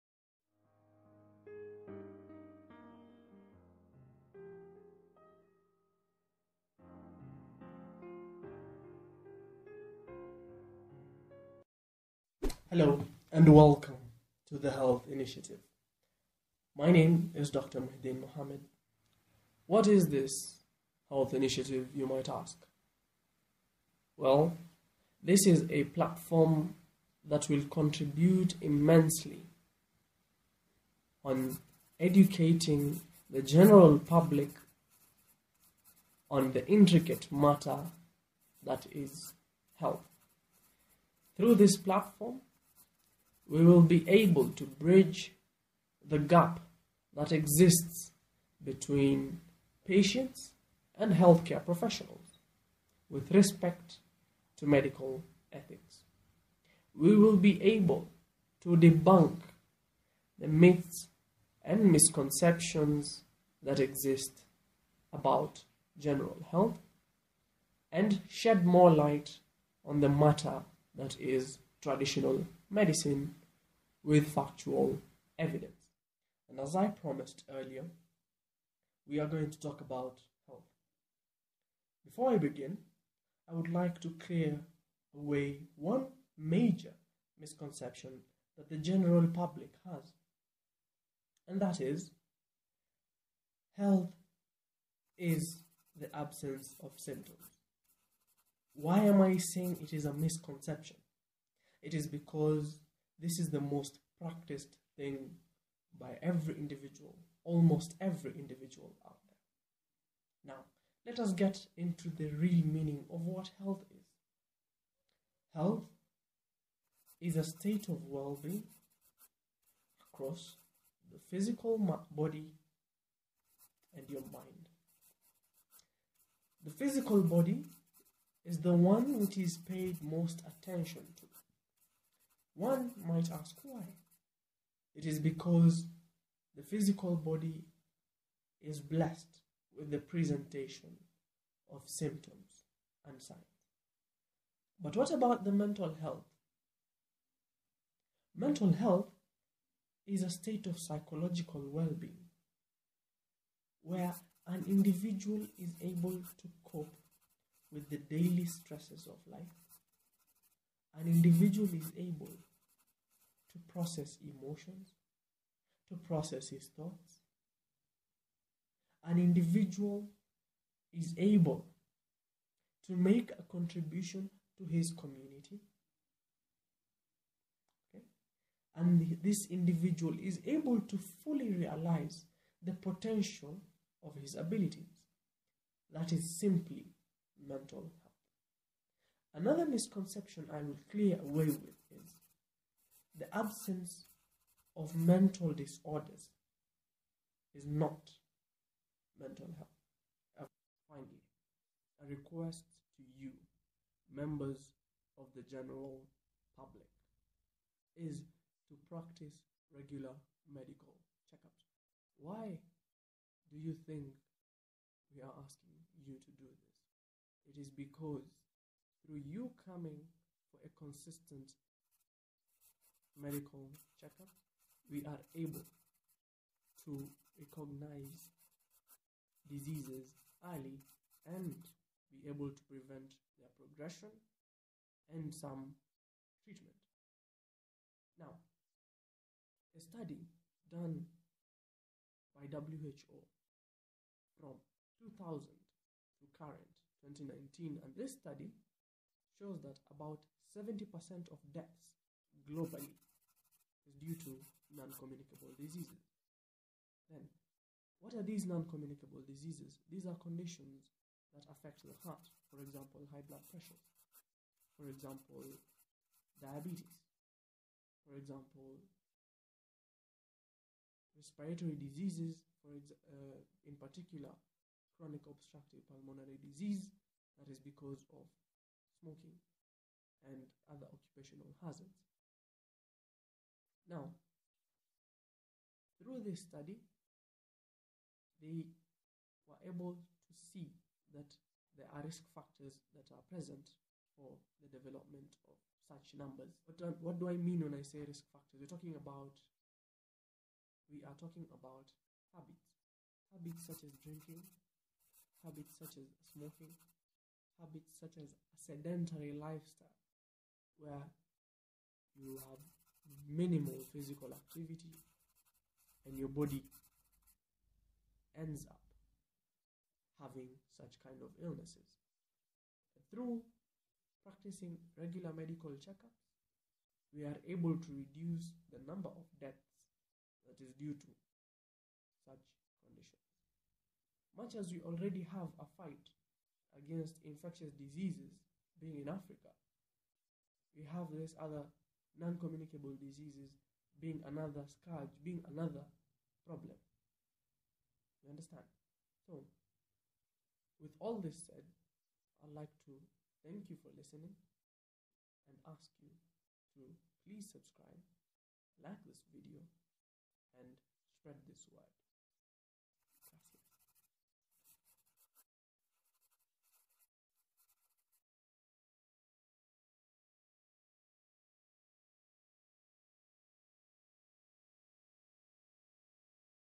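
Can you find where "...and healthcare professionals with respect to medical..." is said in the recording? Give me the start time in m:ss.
0:50.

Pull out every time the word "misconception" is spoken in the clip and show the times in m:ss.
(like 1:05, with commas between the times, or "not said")
1:01, 1:27, 1:40, 3:09.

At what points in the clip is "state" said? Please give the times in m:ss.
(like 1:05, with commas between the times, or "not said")
1:57, 2:30.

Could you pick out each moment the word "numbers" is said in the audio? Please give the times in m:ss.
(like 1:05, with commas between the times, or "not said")
4:56, 5:28.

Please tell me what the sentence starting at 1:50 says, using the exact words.
Now, let us get into the real meaning of what health is.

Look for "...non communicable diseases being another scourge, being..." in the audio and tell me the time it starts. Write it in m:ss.
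5:42.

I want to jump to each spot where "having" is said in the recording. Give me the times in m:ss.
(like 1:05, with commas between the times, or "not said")
5:20.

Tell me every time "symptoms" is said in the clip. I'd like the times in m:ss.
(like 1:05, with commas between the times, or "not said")
1:36, 2:21.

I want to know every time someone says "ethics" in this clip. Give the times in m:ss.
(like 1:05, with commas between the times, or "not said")
0:55.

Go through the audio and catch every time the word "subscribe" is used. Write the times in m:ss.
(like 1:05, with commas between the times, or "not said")
5:57.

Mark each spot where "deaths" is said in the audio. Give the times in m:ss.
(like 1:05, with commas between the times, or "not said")
4:11, 5:29.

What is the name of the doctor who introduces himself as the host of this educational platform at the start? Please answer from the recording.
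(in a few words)
Dr. Mahdeen Mohammed.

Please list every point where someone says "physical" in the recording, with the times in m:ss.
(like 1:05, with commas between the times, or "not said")
2:01, 2:06, 2:16, 5:13.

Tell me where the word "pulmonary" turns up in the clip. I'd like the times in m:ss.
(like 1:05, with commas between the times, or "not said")
4:35.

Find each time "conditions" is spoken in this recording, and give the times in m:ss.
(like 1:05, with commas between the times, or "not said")
4:20, 5:32.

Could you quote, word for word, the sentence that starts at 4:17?
Then, what are these non-communicable diseases?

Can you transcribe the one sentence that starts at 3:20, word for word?
Finally, a request to you, members of the general public, is to practice regular medical checkups.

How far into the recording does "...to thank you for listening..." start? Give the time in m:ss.
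5:52.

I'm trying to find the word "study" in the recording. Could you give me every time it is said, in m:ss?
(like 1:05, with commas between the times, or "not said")
3:59, 4:08, 4:46.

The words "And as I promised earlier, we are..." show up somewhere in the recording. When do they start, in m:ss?
1:16.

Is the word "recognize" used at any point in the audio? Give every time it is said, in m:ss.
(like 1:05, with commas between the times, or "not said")
3:47.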